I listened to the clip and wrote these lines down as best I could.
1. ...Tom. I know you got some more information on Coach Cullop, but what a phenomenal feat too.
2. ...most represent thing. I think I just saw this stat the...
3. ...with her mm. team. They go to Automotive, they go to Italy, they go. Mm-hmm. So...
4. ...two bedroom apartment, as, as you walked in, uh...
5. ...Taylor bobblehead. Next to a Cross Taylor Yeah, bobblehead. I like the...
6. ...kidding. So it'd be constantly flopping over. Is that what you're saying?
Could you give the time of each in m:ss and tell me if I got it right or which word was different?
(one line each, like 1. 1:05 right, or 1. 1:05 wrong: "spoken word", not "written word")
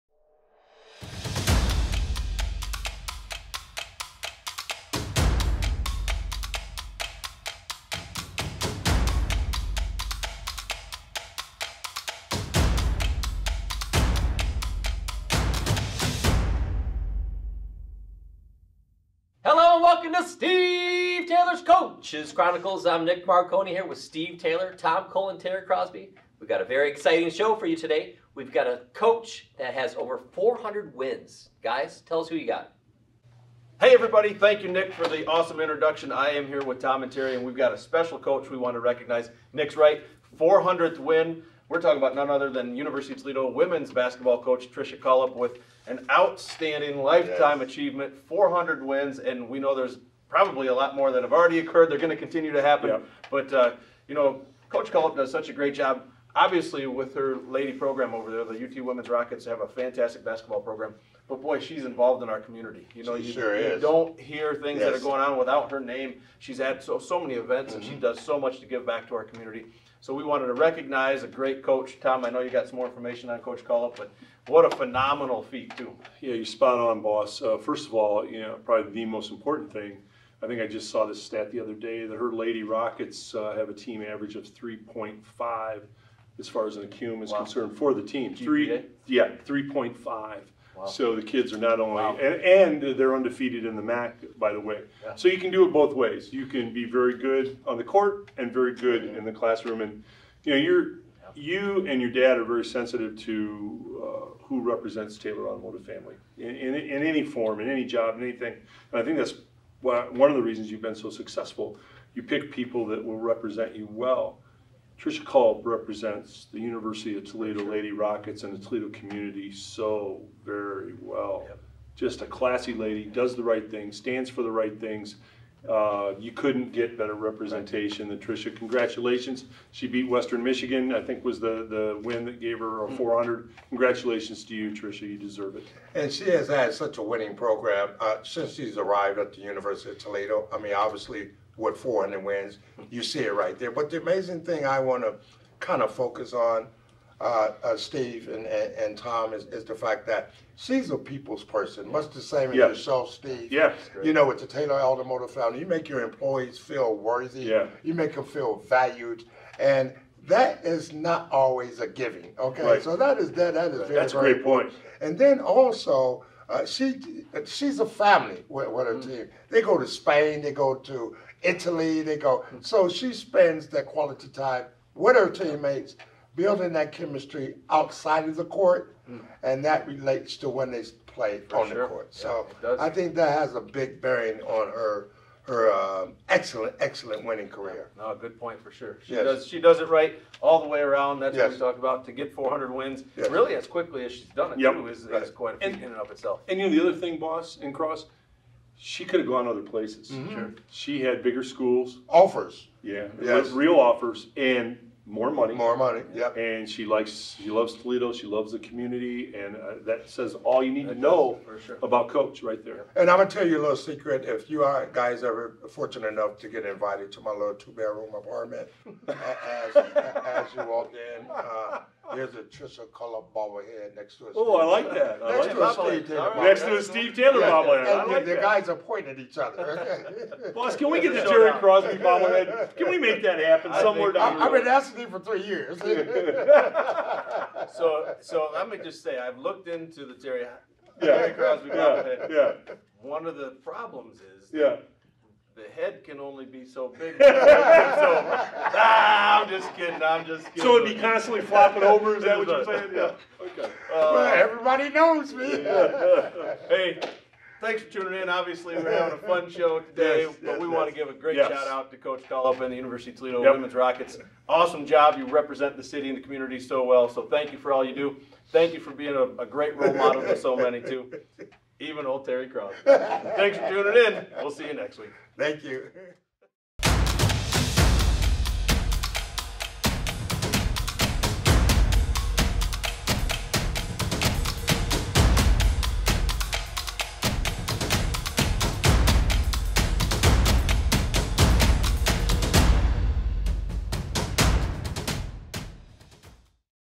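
1. 1:12 right
2. 1:19 wrong: "important", not "represent"
3. 2:48 wrong: "Spain", not "Automotive"
4. 3:37 right
5. 3:46 wrong: "Steve", not "Cross"
6. 4:10 right.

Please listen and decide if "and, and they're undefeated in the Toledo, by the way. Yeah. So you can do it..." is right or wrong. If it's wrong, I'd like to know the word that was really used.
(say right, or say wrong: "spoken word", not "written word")
wrong: "MAC", not "Toledo".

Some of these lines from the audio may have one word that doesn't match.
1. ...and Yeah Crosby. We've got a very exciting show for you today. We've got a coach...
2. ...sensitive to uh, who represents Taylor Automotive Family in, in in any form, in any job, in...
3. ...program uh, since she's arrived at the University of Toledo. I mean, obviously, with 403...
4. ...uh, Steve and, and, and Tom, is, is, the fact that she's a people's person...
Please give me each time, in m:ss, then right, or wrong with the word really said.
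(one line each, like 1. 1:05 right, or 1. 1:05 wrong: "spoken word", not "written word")
1. 0:25 wrong: "Terry", not "Yeah"
2. 1:42 right
3. 2:17 wrong: "400", not "403"
4. 2:27 right.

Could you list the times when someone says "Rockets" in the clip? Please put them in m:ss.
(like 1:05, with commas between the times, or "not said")
0:59, 1:22, 1:57, 4:23.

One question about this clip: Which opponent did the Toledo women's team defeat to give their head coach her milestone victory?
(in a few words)
Western Michigan.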